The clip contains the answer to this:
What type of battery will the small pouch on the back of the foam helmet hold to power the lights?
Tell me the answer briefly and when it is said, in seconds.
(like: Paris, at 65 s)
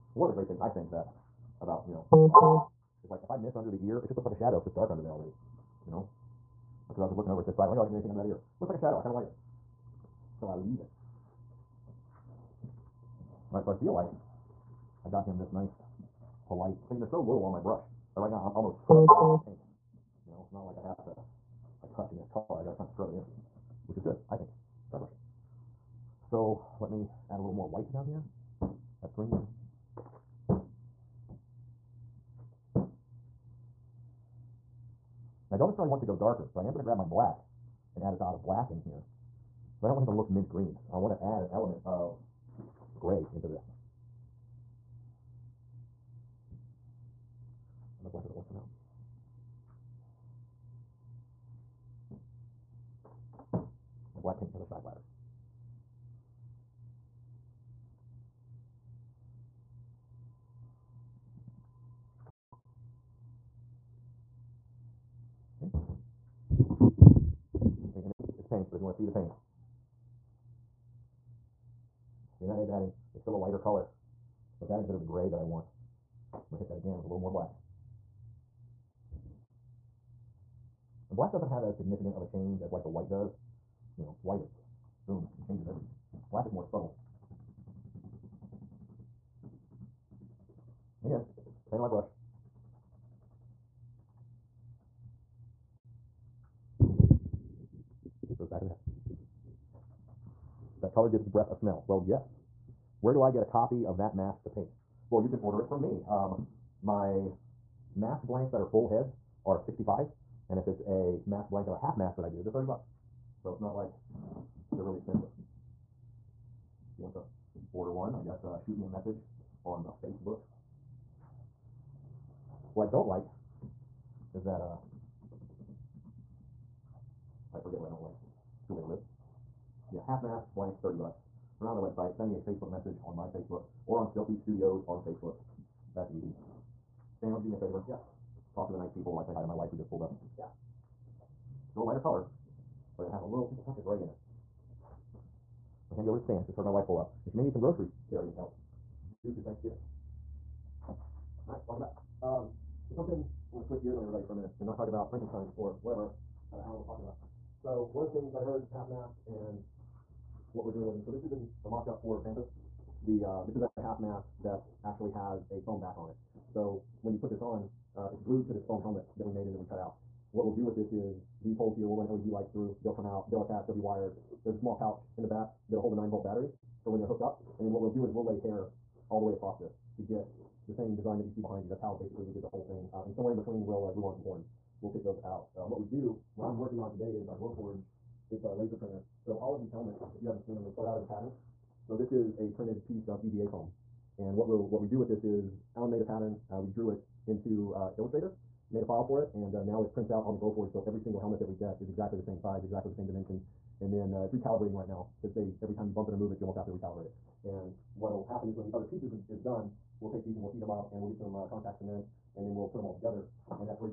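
nine volt, at 175 s.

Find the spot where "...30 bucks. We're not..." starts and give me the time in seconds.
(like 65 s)
130 s.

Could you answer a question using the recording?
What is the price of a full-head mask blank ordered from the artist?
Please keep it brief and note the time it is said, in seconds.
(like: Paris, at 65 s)
65, at 109 s.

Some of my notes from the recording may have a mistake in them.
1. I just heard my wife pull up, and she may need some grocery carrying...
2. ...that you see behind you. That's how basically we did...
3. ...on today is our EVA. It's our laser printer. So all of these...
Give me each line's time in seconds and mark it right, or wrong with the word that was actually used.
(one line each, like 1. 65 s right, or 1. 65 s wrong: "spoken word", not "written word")
1. 146 s right
2. 181 s right
3. 186 s wrong: "Glowforge", not "EVA".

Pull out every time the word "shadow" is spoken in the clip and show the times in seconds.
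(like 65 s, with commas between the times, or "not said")
4 s, 8 s.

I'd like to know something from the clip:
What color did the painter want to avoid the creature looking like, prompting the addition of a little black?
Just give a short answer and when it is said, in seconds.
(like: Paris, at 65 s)
mint green, at 40 s.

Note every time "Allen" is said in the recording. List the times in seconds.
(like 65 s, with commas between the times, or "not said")
156 s, 195 s.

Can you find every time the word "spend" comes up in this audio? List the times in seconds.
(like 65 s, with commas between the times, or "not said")
not said.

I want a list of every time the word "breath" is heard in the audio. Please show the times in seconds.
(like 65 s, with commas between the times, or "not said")
101 s.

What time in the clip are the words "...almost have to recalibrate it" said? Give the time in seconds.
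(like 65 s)
206 s.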